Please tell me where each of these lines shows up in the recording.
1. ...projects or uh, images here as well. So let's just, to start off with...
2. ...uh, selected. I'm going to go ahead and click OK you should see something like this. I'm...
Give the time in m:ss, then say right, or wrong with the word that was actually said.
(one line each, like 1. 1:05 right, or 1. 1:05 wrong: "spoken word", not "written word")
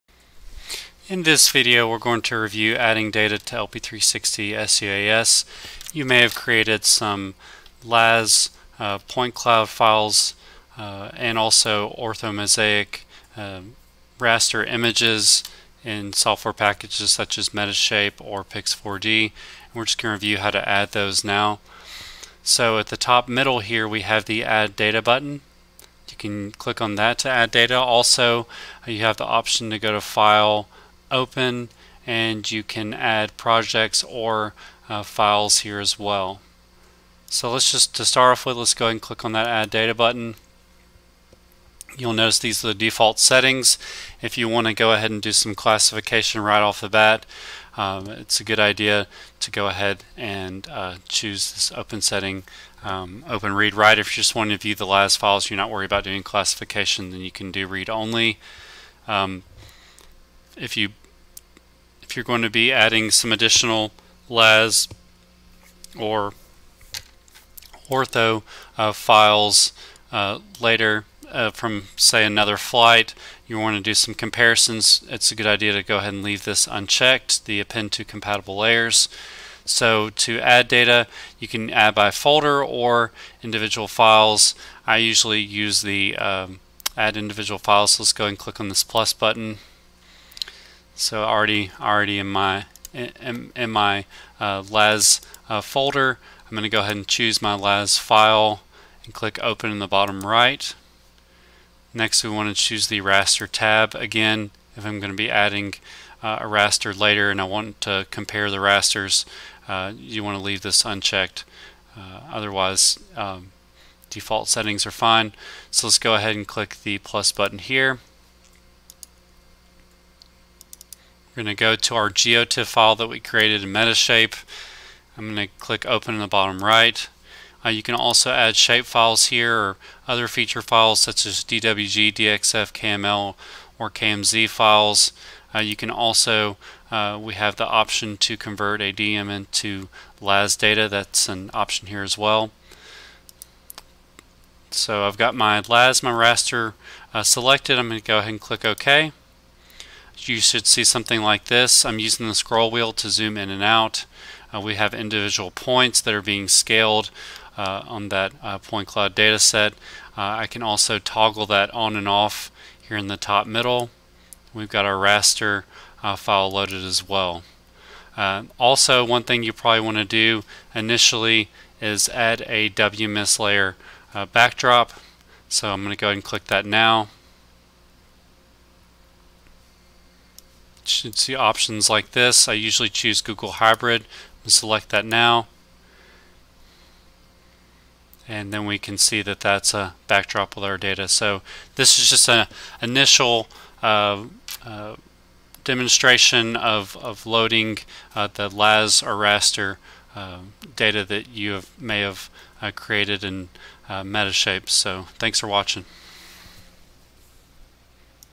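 1. 0:33 wrong: "files", not "images"
2. 2:27 right.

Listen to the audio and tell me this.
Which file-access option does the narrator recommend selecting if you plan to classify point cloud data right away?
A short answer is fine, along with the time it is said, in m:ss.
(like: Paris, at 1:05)
open read write, at 0:53.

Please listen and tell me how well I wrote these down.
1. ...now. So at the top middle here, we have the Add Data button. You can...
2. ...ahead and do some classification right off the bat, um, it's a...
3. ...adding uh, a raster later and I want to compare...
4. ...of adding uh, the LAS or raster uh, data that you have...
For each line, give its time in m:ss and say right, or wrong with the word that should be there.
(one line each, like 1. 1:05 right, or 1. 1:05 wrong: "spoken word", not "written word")
1. 0:21 right
2. 0:44 right
3. 1:45 right
4. 3:16 wrong: "loading", not "adding".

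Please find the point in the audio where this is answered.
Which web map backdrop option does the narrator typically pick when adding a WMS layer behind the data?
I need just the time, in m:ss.
3:03.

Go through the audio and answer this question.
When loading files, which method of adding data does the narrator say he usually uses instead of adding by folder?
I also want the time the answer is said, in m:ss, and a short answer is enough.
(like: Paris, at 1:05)
add individual files, at 1:26.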